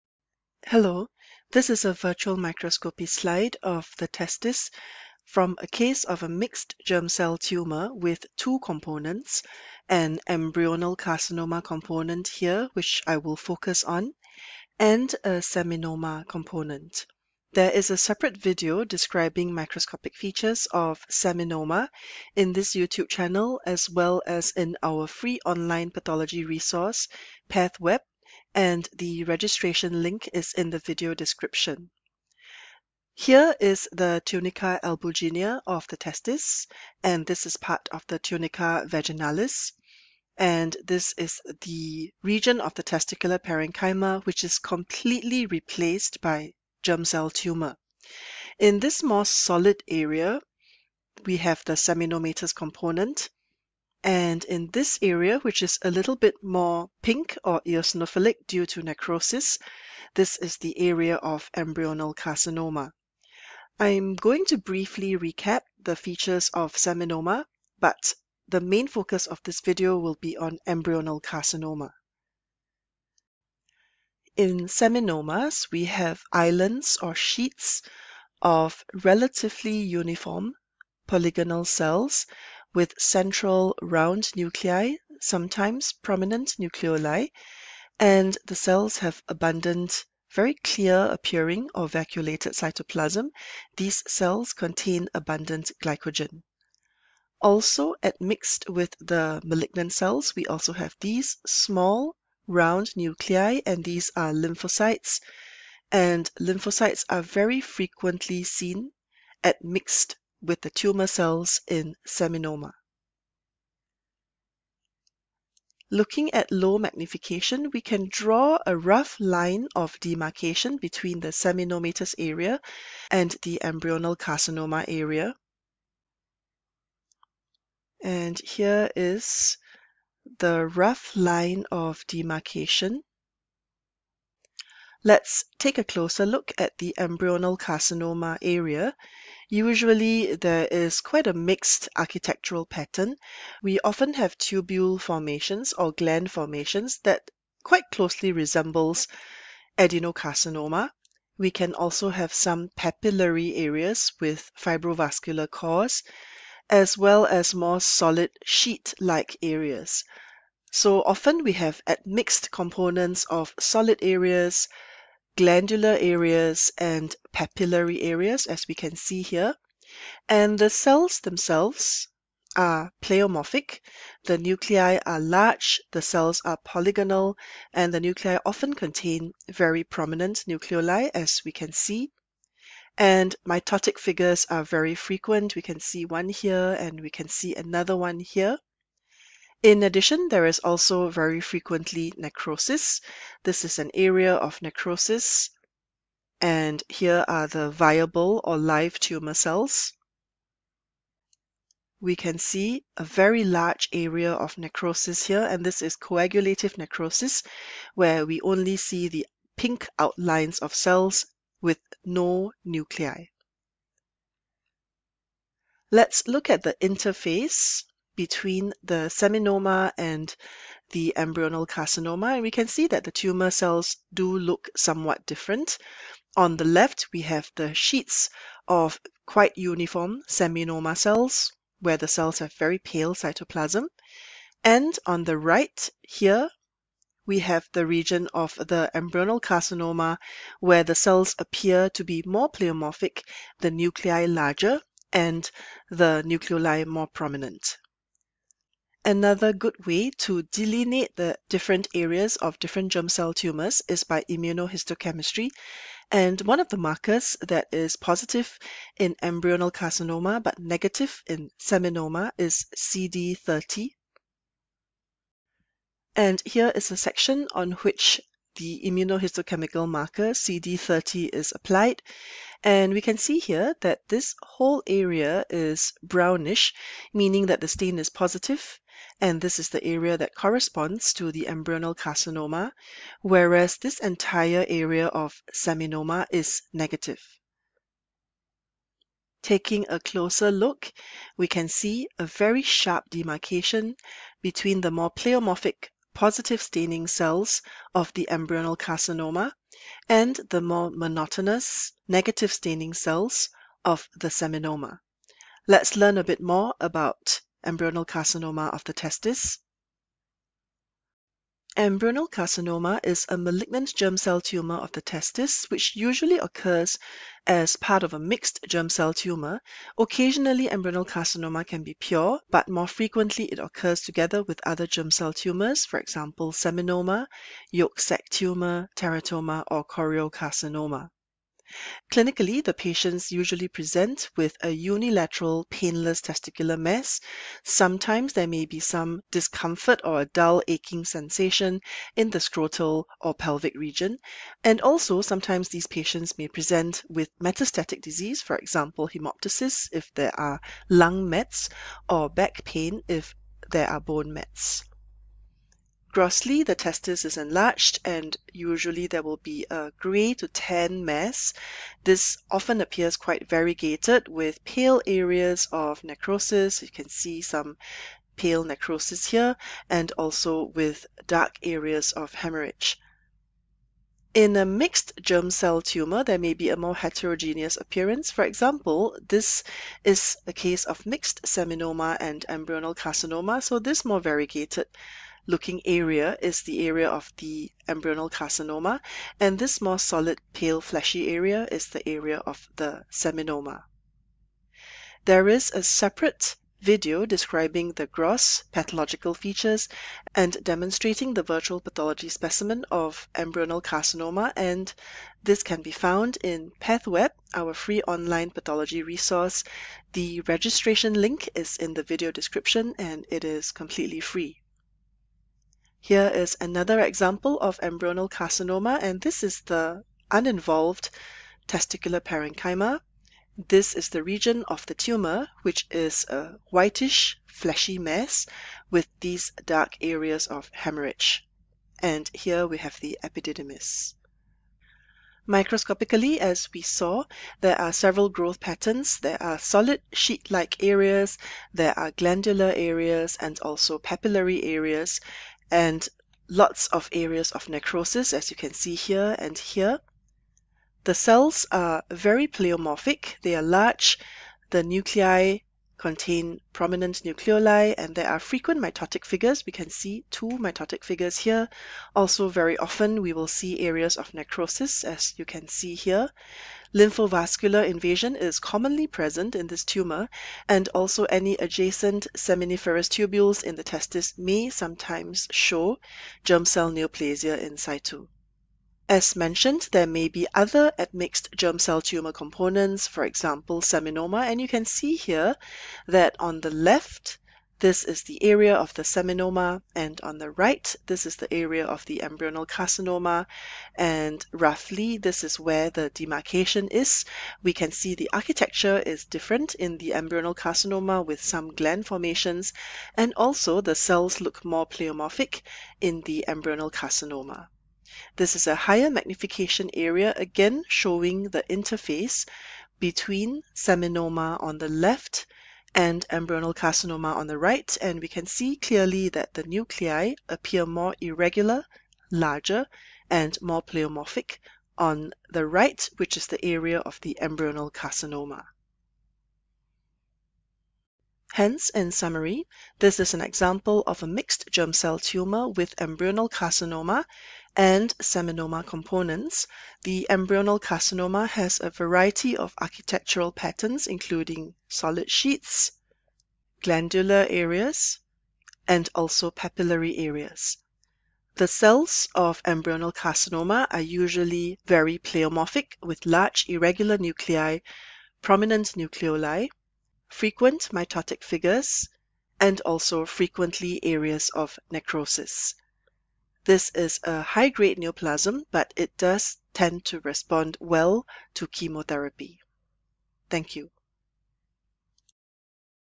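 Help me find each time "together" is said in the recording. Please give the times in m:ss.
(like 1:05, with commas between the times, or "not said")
5:24.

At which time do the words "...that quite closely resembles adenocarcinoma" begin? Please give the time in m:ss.
2:26.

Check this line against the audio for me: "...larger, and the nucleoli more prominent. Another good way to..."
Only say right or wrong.
right.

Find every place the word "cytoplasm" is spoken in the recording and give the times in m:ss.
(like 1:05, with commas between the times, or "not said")
1:32, 3:53.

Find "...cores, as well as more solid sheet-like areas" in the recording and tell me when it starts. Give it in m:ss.
2:35.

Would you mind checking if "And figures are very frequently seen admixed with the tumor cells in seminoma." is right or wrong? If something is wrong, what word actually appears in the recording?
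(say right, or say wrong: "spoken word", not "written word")
wrong: "lymphocytes", not "figures".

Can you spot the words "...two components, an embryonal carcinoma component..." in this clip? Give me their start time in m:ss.
0:08.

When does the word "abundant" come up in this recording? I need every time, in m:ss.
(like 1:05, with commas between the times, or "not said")
1:29, 1:35.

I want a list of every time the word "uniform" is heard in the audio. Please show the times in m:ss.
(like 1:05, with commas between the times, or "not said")
1:19, 3:49.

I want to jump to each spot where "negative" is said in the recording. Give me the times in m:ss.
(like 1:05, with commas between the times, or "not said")
4:20, 4:46, 5:02.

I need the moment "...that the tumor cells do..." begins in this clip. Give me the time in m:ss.
3:42.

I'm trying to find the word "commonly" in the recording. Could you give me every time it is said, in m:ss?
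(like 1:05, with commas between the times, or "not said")
7:48.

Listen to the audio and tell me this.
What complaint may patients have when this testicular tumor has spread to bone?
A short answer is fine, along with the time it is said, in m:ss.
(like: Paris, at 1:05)
Back pain, at 5:52.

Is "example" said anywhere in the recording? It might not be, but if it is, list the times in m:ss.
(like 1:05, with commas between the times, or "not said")
5:25, 5:48, 6:18, 6:57, 8:03, 8:53.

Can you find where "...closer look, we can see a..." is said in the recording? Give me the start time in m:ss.
4:49.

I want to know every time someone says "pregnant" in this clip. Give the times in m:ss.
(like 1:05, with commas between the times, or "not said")
not said.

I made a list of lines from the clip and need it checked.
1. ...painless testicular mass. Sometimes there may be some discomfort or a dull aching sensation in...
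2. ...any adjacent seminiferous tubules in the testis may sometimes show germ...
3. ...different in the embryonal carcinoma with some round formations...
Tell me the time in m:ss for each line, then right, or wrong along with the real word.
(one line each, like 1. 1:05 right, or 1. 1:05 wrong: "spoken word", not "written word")
1. 5:35 right
2. 7:51 right
3. 8:19 wrong: "gland", not "round".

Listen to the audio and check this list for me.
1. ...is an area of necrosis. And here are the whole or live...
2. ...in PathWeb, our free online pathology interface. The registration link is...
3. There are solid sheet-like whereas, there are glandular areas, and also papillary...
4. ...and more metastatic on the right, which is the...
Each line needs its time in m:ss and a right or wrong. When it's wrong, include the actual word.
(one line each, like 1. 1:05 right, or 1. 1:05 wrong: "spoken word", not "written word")
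1. 3:13 wrong: "viable", not "whole"
2. 6:46 wrong: "resource", not "interface"
3. 7:19 wrong: "areas", not "whereas"
4. 8:43 wrong: "pleomorphic", not "metastatic".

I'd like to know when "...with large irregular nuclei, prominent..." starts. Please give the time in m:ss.
9:16.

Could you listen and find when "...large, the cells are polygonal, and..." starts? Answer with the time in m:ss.
2:55.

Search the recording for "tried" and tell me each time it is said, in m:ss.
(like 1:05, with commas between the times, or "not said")
not said.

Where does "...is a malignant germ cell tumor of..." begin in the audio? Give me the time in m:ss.
5:13.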